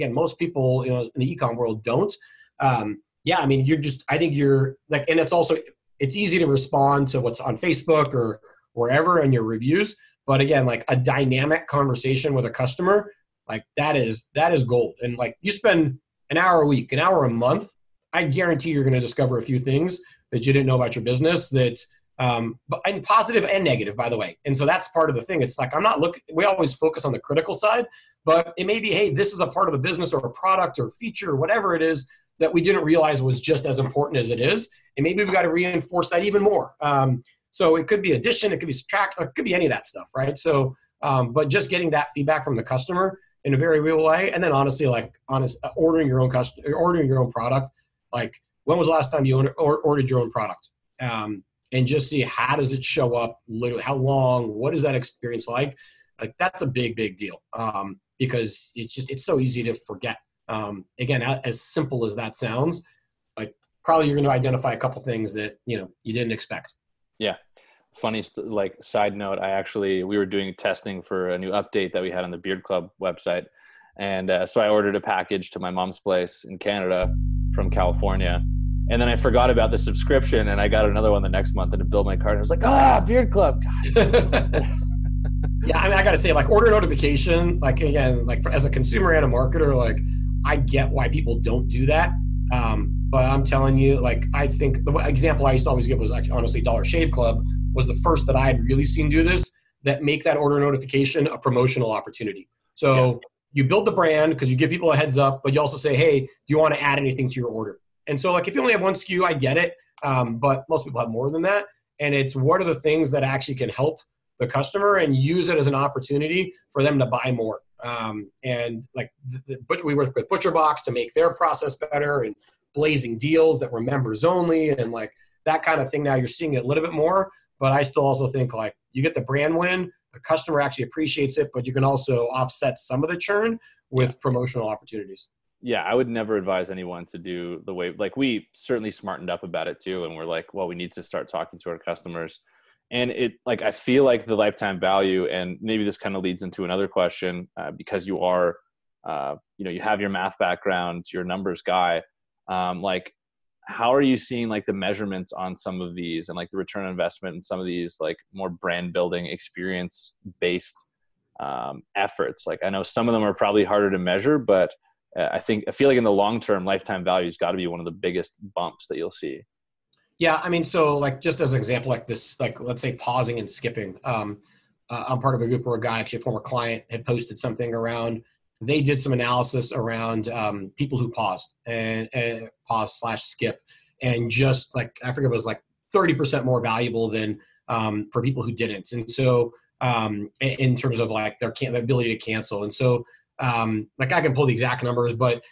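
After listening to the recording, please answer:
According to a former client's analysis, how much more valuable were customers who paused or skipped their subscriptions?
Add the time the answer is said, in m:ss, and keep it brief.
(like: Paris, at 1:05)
30%, at 3:05.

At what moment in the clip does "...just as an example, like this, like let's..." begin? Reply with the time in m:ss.
2:51.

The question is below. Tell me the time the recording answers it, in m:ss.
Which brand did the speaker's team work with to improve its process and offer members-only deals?
2:00.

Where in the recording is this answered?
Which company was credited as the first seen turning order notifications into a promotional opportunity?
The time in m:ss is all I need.
1:36.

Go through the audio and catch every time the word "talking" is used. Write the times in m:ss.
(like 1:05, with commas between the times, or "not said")
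2:21.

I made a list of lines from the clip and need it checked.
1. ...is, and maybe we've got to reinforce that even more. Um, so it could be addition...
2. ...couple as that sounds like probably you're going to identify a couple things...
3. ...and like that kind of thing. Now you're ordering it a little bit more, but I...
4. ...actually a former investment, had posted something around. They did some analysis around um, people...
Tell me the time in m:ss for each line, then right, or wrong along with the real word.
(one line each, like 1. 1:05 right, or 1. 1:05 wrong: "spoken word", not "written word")
1. 0:34 right
2. 1:01 wrong: "simple", not "couple"
3. 2:04 wrong: "seeing", not "ordering"
4. 2:55 wrong: "client", not "investment".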